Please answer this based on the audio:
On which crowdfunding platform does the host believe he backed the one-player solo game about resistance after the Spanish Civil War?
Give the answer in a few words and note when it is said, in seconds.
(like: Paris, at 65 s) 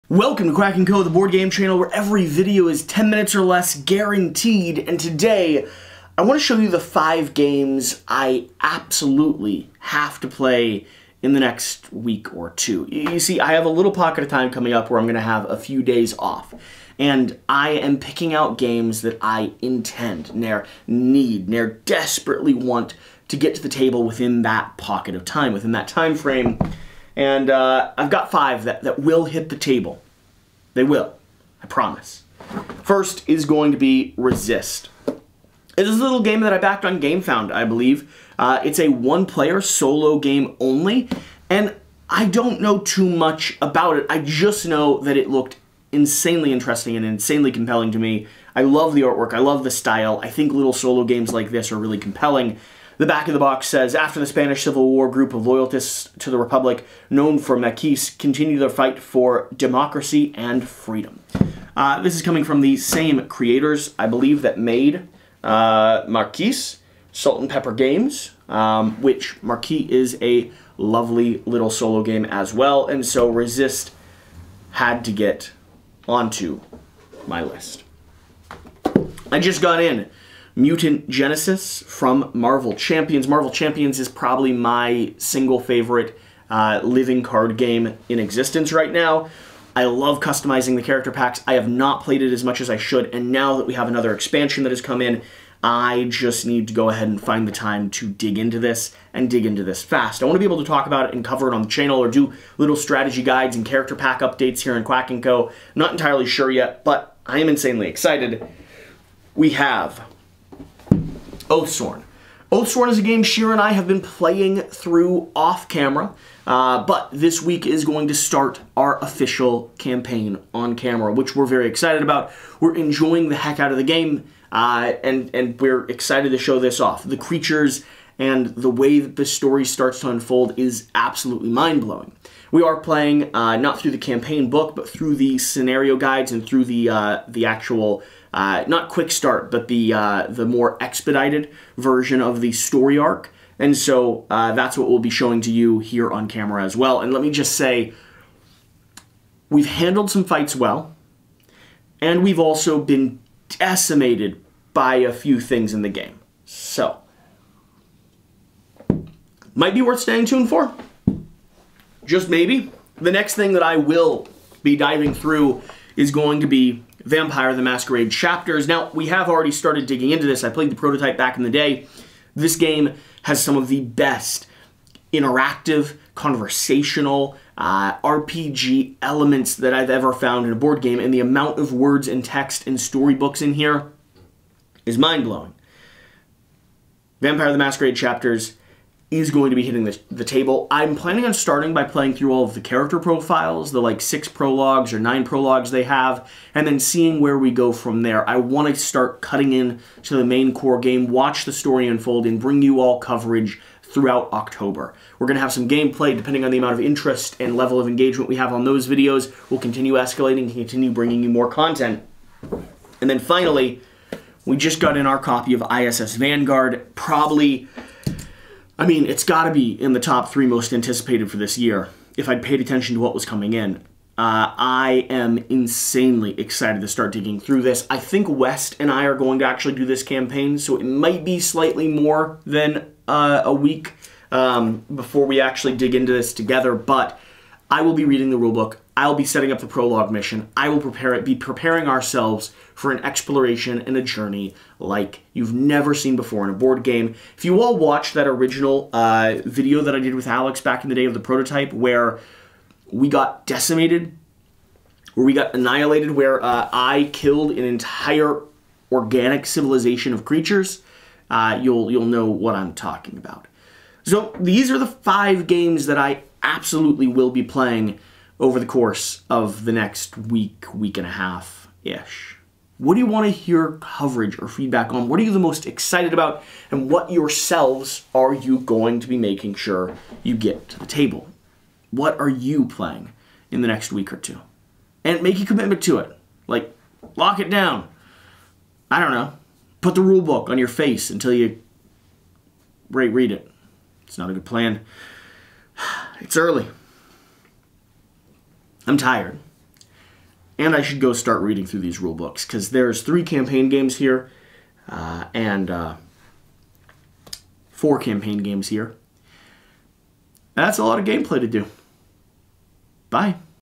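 GameFound, at 36 s.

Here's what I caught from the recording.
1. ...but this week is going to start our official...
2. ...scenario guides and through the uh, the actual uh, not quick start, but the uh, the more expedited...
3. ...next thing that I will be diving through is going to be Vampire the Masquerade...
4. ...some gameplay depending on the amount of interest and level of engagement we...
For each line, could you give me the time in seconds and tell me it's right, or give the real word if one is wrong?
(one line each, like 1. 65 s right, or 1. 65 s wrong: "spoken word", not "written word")
1. 116 s right
2. 135 s right
3. 163 s right
4. 205 s right.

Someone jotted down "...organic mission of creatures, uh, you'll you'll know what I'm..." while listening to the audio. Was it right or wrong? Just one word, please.
wrong.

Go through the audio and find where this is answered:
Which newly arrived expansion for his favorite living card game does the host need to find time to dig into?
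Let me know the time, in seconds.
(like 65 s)
80 s.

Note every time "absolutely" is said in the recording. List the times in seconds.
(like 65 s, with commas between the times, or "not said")
8 s, 130 s, 266 s.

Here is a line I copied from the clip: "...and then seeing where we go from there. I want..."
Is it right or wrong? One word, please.
right.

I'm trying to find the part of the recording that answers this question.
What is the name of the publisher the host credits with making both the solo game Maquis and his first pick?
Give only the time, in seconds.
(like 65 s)
67 s.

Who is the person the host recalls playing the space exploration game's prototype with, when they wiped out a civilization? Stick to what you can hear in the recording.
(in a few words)
Alex.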